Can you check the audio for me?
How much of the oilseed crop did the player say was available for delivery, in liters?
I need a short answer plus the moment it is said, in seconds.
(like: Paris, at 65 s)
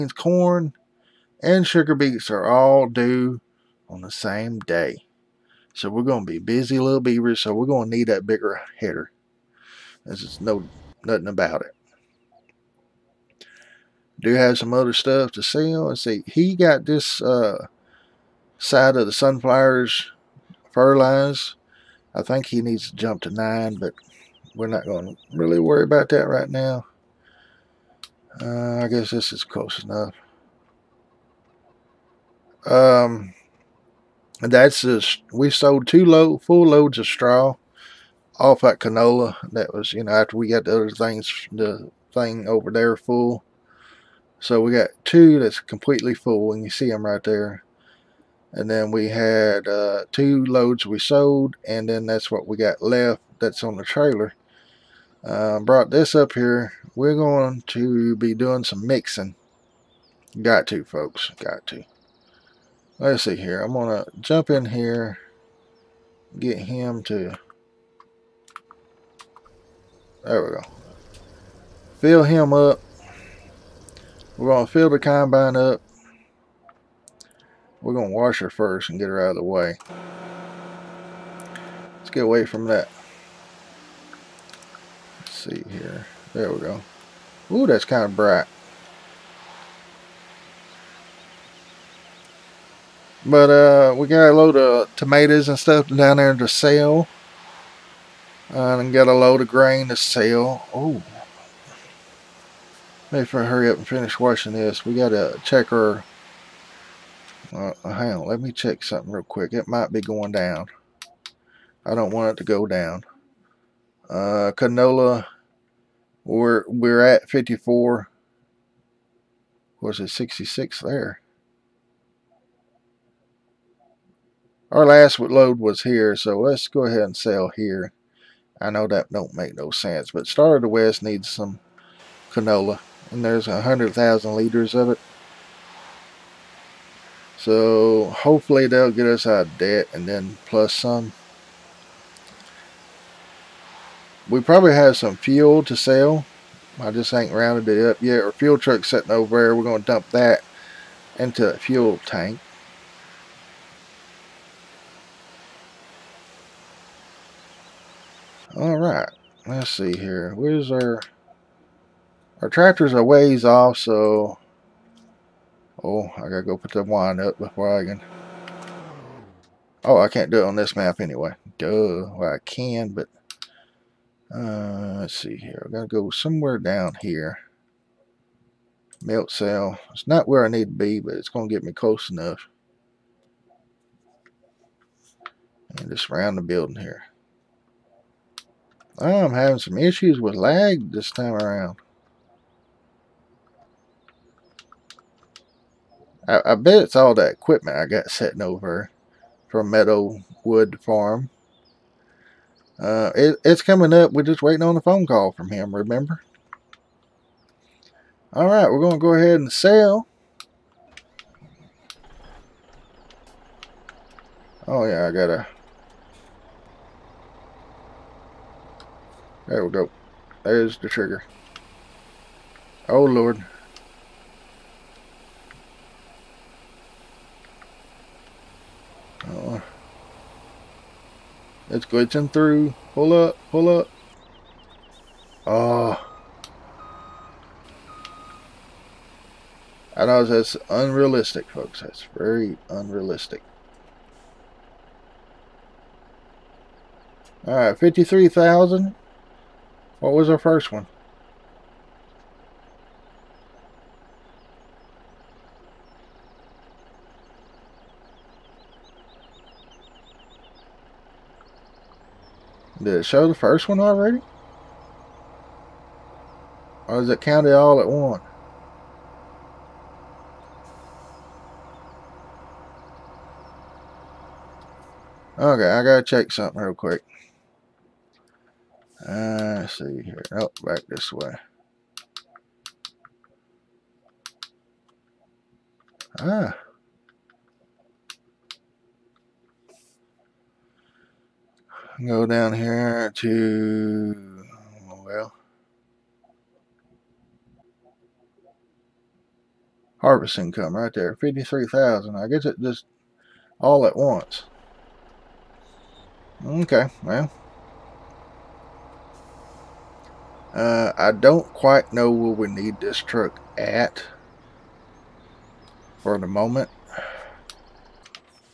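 100,000 liters, at 133 s.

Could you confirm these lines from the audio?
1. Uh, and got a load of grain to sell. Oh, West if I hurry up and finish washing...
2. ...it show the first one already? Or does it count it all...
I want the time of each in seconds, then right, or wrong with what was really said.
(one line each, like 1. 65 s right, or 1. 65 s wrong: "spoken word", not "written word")
1. 98 s wrong: "Maybe", not "West"
2. 262 s right.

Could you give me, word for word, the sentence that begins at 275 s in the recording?
Okay, I gotta check something real quick.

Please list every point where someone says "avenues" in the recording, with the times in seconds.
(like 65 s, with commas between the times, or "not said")
not said.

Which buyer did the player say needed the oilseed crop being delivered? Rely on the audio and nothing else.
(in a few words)
Star of the West.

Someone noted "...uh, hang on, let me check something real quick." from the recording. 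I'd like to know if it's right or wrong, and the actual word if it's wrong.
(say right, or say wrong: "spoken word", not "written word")
right.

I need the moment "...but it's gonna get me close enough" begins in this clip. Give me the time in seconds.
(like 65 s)
180 s.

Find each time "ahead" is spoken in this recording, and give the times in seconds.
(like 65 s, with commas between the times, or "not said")
126 s, 209 s.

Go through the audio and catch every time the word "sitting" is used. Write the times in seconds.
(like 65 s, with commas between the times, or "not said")
148 s, 198 s.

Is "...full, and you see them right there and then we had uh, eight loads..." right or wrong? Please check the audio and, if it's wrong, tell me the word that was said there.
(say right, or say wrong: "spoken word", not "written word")
wrong: "two", not "eight".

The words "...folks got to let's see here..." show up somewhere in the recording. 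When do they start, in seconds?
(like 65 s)
60 s.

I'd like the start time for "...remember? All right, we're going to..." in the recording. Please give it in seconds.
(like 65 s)
205 s.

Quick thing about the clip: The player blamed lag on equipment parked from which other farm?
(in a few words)
Meadowwood Farm.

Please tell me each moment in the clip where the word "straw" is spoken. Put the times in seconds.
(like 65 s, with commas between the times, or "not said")
37 s.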